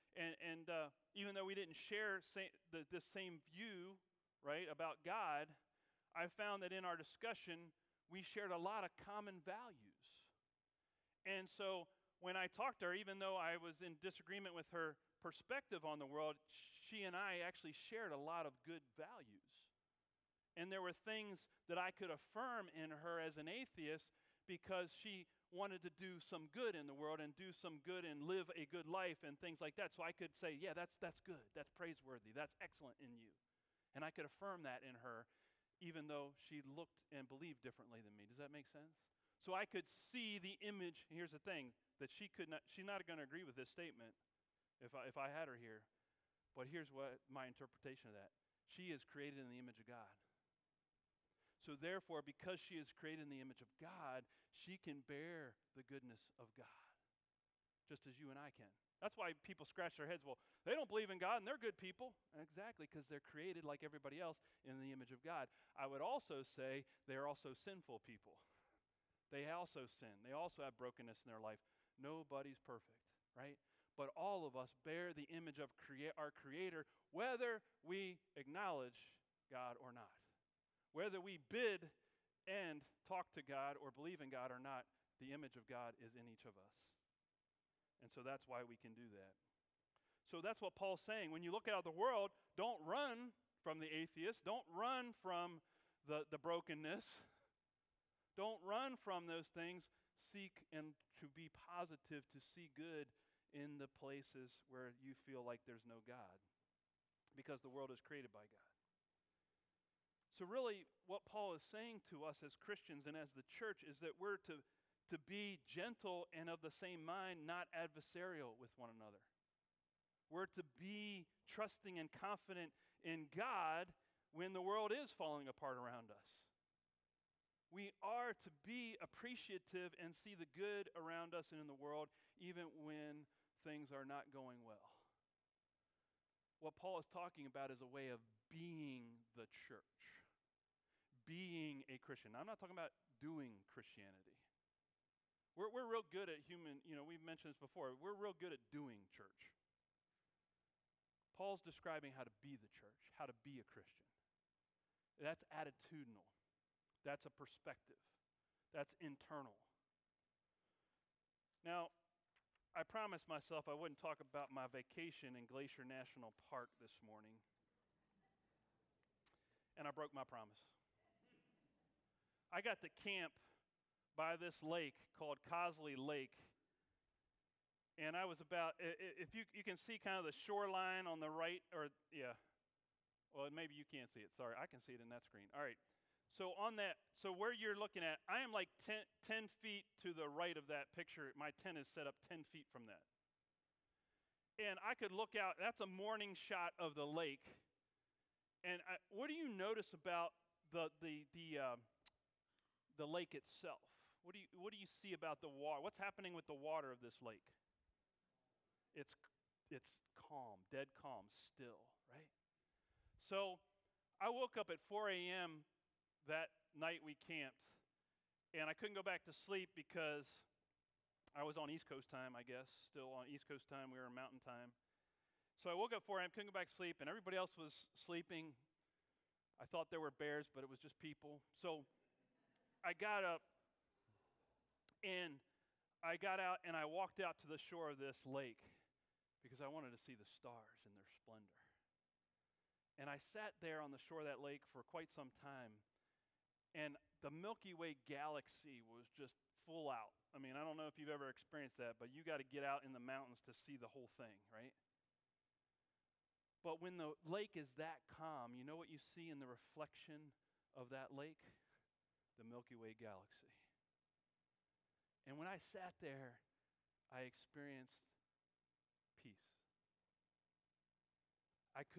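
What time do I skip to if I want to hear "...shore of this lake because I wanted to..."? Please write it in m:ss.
3:57.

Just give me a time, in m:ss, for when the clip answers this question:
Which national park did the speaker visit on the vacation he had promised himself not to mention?
2:45.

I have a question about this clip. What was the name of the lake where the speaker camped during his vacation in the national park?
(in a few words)
Cosley Lake.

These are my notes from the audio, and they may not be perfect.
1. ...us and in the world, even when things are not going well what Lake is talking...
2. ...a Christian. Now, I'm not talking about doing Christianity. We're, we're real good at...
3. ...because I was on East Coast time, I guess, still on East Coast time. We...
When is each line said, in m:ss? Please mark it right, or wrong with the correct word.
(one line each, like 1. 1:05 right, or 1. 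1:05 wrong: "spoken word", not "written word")
1. 2:11 wrong: "Paul", not "Lake"
2. 2:21 right
3. 3:39 right.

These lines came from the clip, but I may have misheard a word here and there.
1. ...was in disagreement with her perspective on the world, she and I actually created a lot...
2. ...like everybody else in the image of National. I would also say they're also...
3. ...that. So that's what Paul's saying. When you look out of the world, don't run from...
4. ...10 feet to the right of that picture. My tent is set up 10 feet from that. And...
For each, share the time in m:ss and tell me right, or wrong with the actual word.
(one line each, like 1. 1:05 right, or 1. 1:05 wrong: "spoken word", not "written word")
1. 0:13 wrong: "shared", not "created"
2. 1:03 wrong: "God", not "National"
3. 1:29 right
4. 3:09 right.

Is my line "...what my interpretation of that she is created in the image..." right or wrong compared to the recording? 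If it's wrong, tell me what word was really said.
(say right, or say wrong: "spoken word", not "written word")
right.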